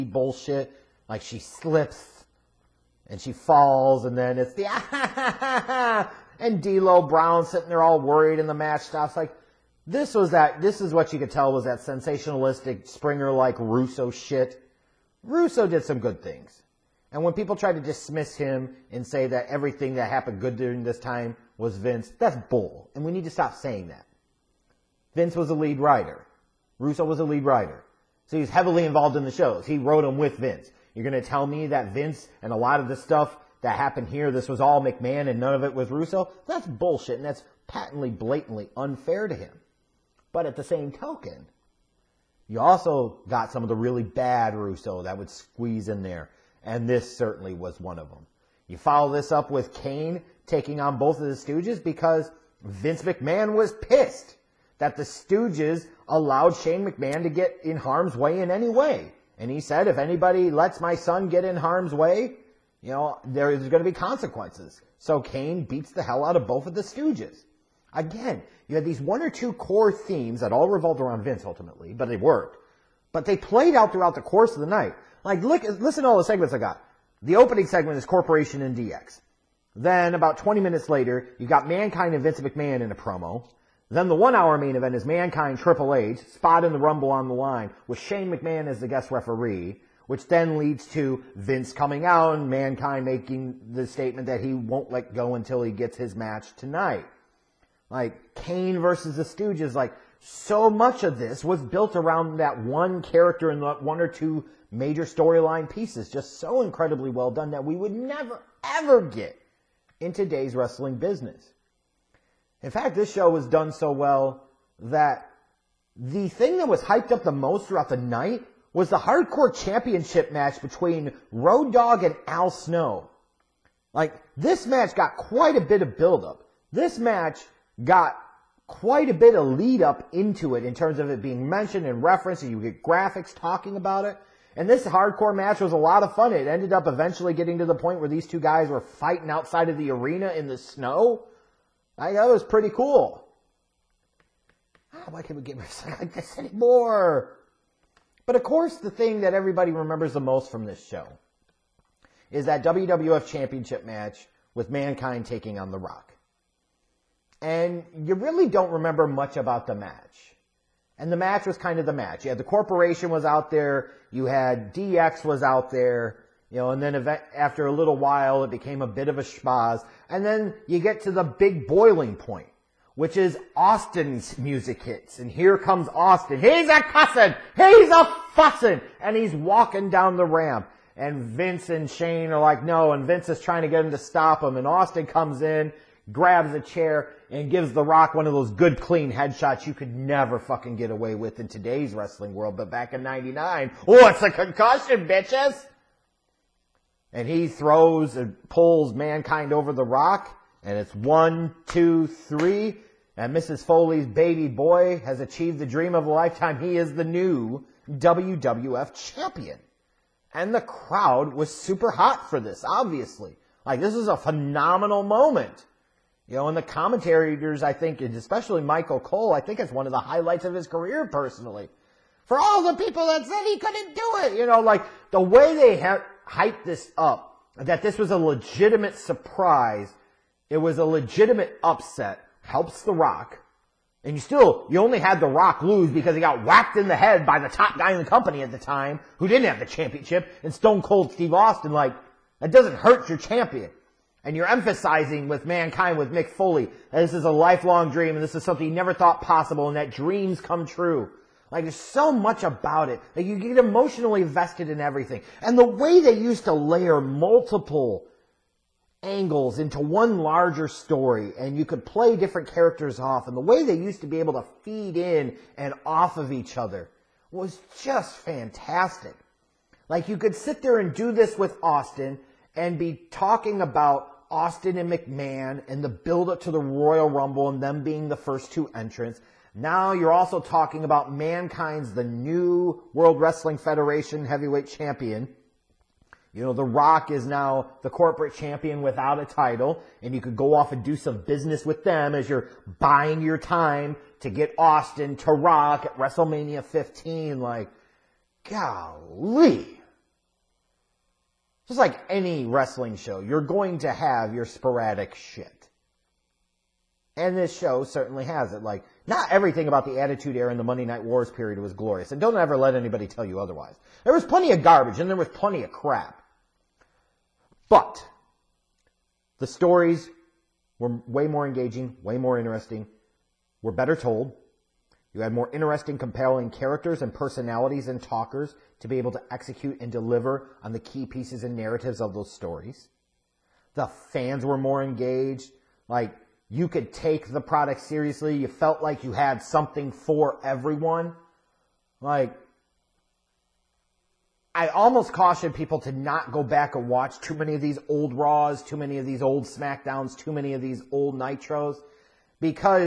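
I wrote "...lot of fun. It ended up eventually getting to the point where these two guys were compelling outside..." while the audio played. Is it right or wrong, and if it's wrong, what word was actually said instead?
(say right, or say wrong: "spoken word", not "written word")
wrong: "fighting", not "compelling".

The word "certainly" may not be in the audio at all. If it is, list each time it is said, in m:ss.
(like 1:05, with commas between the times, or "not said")
0:47, 5:07.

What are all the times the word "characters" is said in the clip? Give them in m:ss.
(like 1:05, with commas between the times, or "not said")
1:43, 4:22, 5:26.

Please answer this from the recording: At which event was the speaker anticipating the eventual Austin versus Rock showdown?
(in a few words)
WrestleMania 15.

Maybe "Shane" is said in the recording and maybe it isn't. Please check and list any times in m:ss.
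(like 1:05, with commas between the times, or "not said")
0:56, 1:27, 3:01.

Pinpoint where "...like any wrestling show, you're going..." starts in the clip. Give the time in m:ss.
5:01.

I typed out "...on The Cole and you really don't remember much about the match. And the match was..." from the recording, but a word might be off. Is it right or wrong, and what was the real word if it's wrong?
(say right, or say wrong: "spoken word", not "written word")
wrong: "Rock", not "Cole".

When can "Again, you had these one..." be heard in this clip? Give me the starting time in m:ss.
1:07.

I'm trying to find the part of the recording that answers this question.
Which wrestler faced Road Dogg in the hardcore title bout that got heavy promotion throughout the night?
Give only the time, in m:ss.
2:02.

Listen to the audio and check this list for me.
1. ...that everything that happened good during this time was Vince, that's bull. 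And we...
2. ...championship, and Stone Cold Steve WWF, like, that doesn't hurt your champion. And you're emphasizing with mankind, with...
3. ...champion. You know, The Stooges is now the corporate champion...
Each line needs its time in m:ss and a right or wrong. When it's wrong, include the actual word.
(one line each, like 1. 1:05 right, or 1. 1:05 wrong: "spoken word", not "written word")
1. 0:19 right
2. 3:59 wrong: "Austin", not "WWF"
3. 4:44 wrong: "Rock", not "Stooges".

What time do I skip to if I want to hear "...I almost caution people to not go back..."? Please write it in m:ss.
5:44.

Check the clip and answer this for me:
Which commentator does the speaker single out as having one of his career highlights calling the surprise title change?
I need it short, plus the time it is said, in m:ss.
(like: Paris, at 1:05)
Michael Cole, at 3:38.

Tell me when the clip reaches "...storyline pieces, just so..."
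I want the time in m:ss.
1:45.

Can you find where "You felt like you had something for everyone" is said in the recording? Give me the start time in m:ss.
5:38.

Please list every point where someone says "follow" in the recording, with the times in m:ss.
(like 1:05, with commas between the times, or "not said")
0:48.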